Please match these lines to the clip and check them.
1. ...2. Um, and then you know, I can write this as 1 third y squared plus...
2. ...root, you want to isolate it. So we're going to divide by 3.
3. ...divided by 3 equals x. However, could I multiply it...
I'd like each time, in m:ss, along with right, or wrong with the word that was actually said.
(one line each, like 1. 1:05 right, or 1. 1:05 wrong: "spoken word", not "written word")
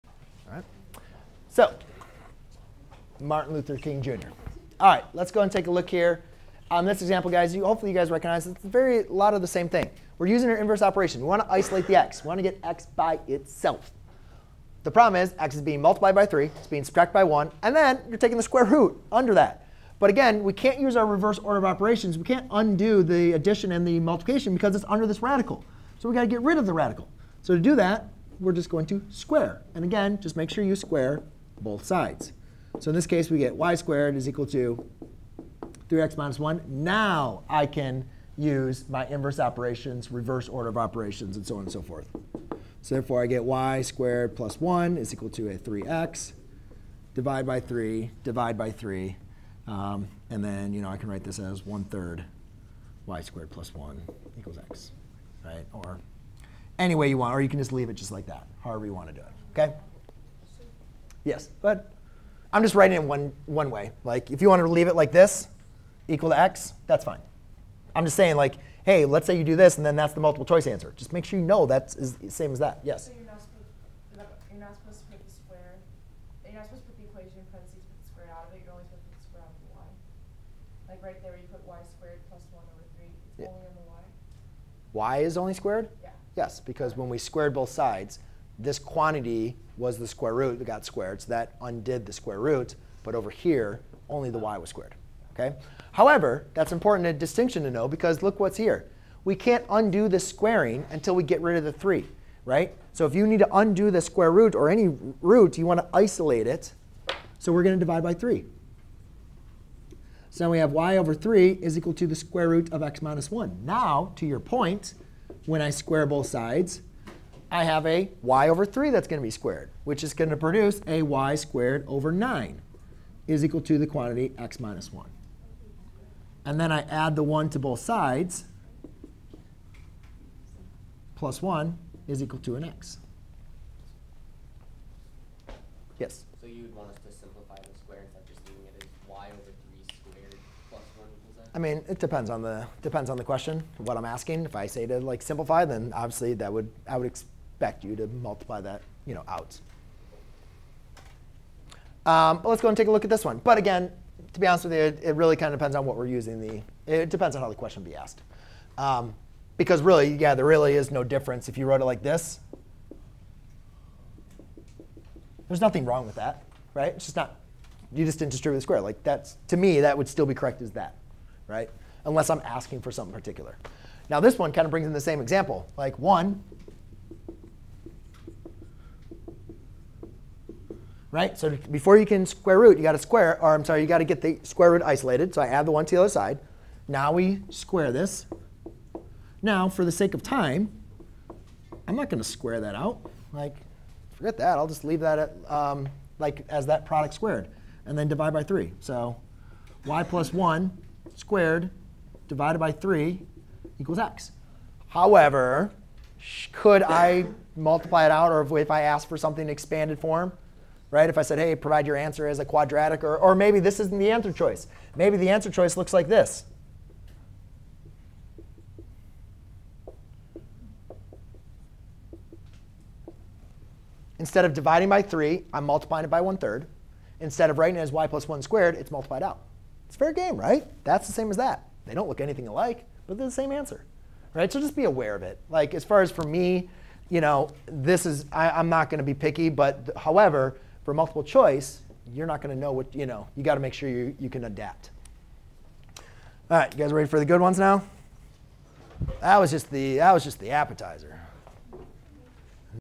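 1. 0:48 wrong: "3", not "2"
2. 1:45 right
3. 3:22 right.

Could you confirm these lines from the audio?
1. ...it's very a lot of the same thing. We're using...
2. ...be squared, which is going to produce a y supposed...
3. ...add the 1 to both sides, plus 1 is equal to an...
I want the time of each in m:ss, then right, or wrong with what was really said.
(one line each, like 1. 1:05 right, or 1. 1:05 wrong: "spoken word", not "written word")
1. 0:08 right
2. 1:59 wrong: "squared", not "supposed"
3. 2:06 right.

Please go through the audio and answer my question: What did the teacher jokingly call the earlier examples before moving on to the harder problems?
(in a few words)
the appetizer.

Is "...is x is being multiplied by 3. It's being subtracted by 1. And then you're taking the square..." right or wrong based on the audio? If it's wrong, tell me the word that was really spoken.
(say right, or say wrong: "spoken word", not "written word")
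right.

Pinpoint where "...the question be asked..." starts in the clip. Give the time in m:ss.
2:37.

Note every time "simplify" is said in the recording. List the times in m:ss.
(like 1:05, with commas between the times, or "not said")
2:17, 2:25.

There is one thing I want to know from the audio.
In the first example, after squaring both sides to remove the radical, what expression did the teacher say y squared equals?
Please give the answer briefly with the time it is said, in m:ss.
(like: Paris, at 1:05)
3x minus 1, at 0:35.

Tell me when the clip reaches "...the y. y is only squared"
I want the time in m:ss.
1:23.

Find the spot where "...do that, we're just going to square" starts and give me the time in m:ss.
0:27.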